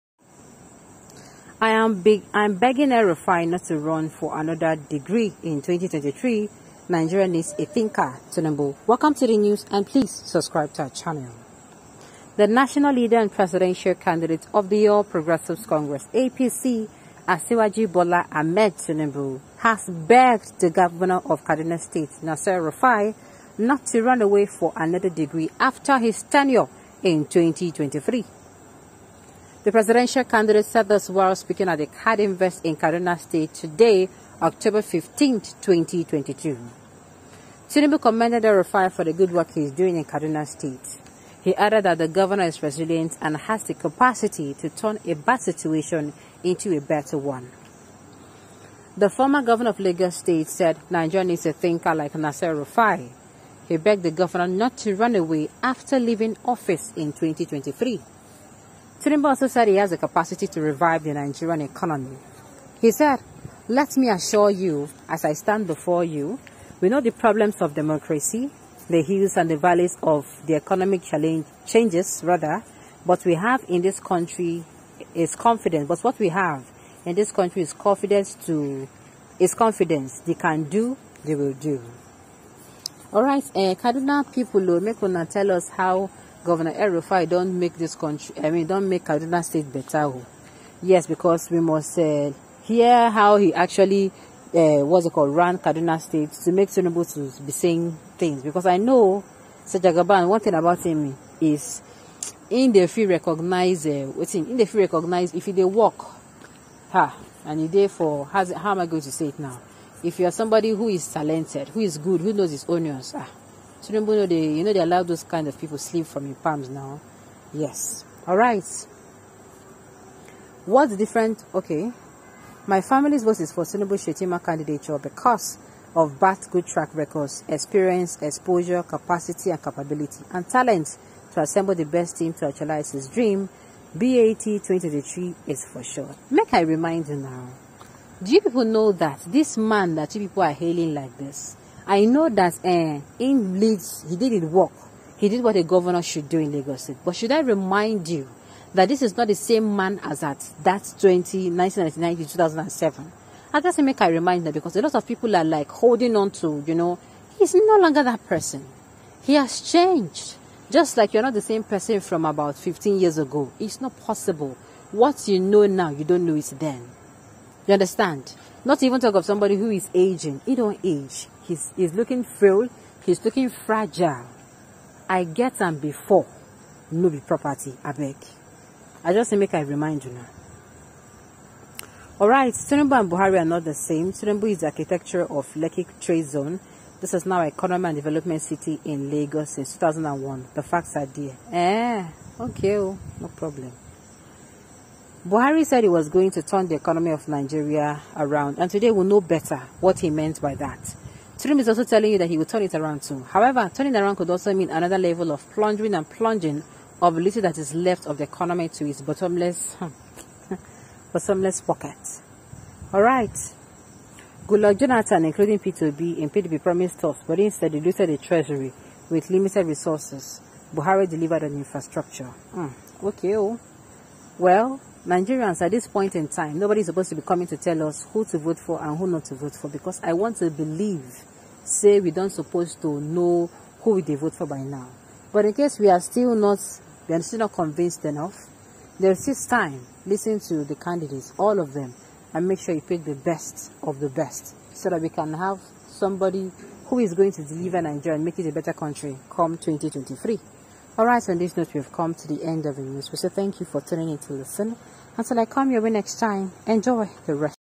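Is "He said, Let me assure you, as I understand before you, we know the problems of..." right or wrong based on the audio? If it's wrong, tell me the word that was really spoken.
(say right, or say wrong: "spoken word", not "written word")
wrong: "stand", not "understand".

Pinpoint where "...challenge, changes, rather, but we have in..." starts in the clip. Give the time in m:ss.
1:11.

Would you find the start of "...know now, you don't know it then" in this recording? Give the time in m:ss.
2:45.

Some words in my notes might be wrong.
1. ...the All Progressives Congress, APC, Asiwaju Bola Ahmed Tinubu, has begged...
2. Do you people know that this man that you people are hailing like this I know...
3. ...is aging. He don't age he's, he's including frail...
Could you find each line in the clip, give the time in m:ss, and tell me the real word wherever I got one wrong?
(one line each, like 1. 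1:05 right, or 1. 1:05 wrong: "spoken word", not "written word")
1. 0:14 right
2. 2:18 right
3. 2:49 wrong: "looking", not "including".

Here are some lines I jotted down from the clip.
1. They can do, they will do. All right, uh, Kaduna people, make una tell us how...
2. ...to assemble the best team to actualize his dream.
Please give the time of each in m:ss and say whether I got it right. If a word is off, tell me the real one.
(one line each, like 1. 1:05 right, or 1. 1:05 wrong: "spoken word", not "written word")
1. 1:20 right
2. 2:11 right.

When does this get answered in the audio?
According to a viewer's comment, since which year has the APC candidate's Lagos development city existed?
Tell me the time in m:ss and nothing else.
3:09.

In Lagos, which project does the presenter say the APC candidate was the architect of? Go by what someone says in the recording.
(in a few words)
Lekki Trade Zone.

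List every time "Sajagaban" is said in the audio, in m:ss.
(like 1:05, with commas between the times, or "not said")
1:39.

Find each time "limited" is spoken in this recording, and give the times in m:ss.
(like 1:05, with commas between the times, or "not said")
3:39.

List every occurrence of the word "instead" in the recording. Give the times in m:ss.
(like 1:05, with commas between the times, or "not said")
3:37.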